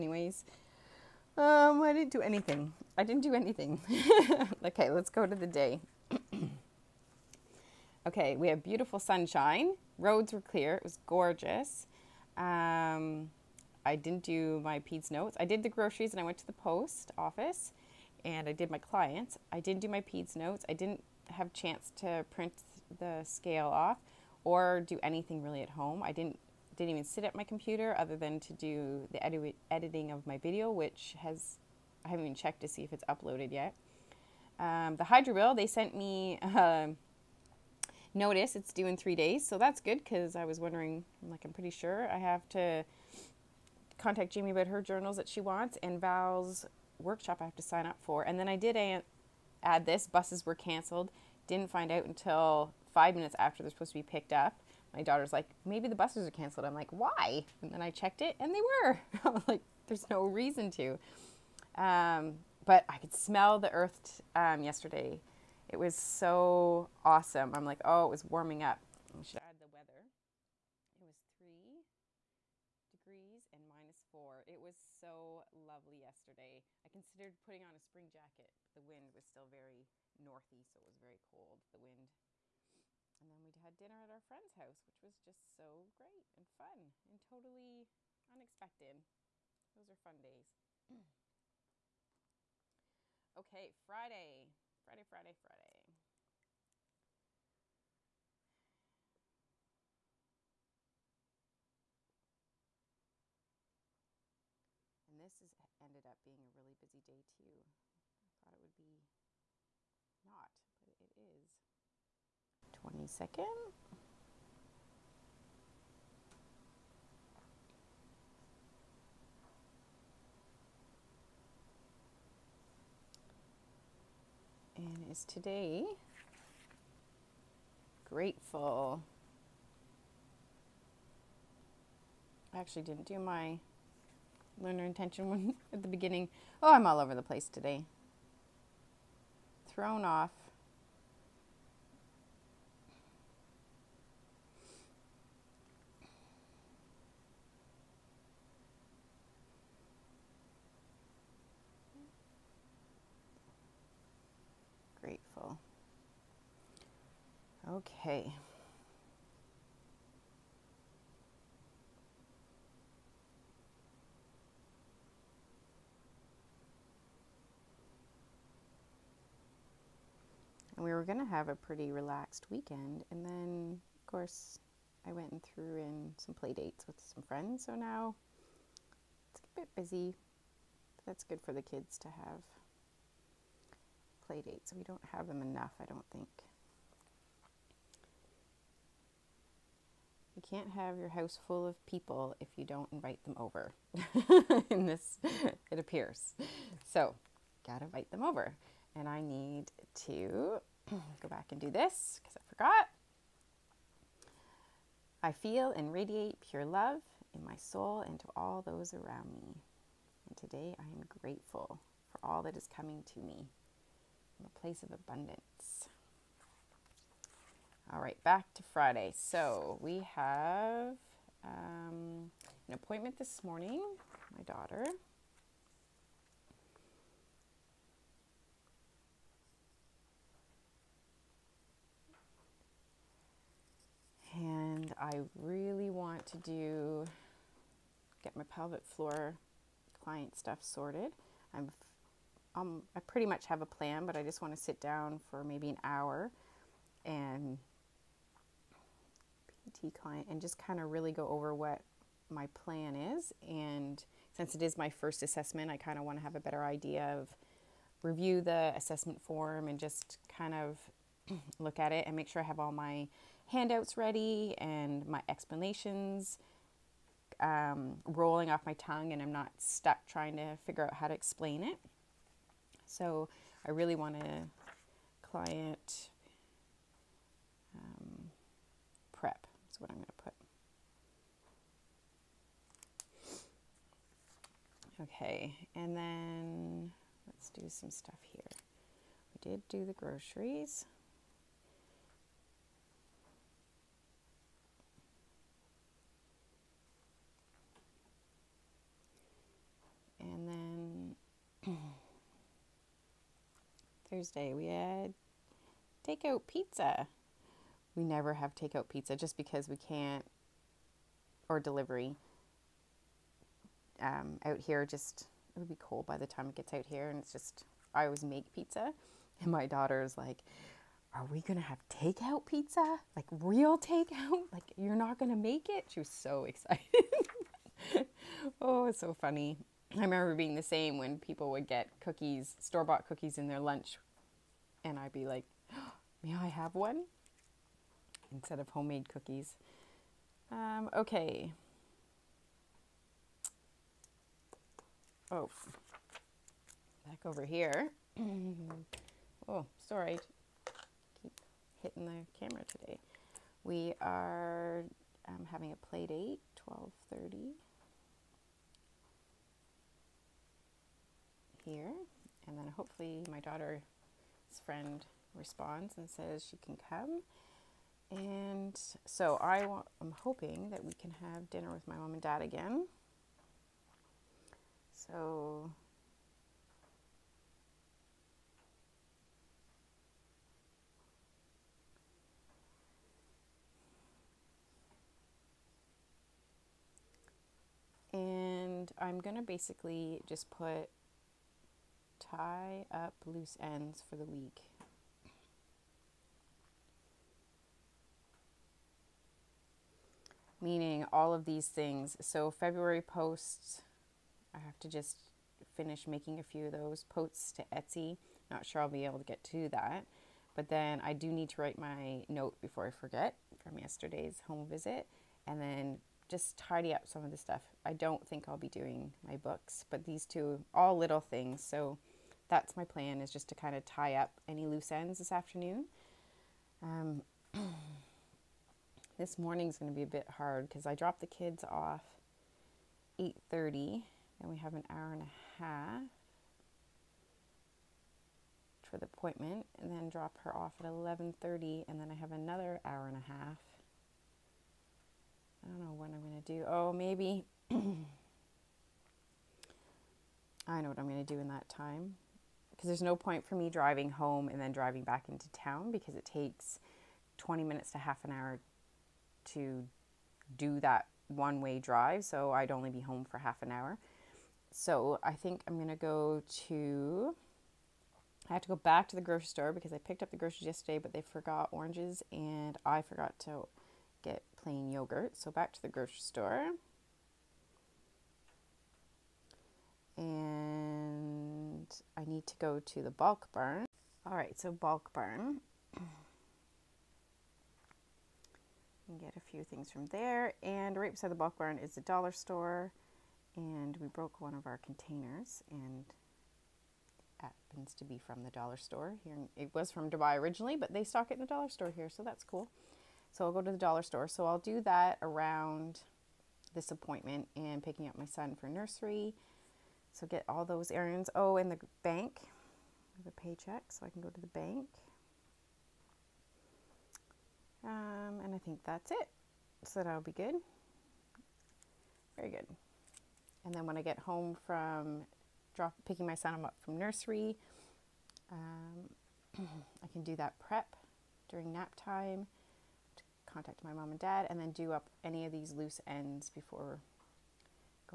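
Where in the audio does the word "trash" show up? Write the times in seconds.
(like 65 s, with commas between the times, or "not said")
not said.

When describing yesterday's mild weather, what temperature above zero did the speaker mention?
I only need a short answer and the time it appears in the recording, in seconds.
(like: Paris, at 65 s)
3 degrees, at 71 s.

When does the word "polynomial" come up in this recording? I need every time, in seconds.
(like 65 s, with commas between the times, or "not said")
not said.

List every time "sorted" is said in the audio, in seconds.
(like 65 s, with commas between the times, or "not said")
240 s.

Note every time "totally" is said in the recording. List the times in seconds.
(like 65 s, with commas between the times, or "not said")
87 s.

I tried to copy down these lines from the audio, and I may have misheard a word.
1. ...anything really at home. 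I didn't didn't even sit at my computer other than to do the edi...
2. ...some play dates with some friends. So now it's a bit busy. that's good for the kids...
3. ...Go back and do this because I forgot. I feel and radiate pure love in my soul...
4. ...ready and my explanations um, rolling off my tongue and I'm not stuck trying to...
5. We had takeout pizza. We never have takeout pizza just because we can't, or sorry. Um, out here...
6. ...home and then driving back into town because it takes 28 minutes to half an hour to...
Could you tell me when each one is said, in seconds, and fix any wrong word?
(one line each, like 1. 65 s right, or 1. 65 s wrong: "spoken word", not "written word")
1. 25 s right
2. 176 s right
3. 201 s right
4. 263 s right
5. 304 s wrong: "delivery", not "sorry"
6. 454 s wrong: "20", not "28".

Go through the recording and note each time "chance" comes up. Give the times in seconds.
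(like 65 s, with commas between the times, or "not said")
21 s.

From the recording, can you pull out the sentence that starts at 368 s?
And so I am hoping that we can have dinner with my mom and dad again.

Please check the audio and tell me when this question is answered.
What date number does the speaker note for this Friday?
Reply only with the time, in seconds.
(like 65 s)
112 s.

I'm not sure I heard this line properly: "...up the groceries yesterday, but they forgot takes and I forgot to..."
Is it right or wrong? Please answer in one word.
wrong.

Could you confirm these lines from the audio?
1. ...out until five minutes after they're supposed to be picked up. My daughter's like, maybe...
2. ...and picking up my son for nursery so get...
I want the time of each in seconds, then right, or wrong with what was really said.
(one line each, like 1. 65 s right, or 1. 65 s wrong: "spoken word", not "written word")
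1. 51 s right
2. 507 s right.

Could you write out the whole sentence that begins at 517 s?
Um, and I think that's it.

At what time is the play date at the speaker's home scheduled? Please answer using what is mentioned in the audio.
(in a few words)
12:30.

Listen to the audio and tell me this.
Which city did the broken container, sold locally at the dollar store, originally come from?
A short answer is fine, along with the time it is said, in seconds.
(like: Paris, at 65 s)
Dubai, at 500 s.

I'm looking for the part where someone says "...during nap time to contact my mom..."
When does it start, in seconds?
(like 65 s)
531 s.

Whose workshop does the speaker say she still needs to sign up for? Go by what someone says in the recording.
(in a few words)
Val.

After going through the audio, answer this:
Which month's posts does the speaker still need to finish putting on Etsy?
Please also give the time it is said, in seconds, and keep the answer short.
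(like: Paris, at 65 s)
February, at 402 s.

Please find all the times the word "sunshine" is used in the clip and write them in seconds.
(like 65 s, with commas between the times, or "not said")
8 s.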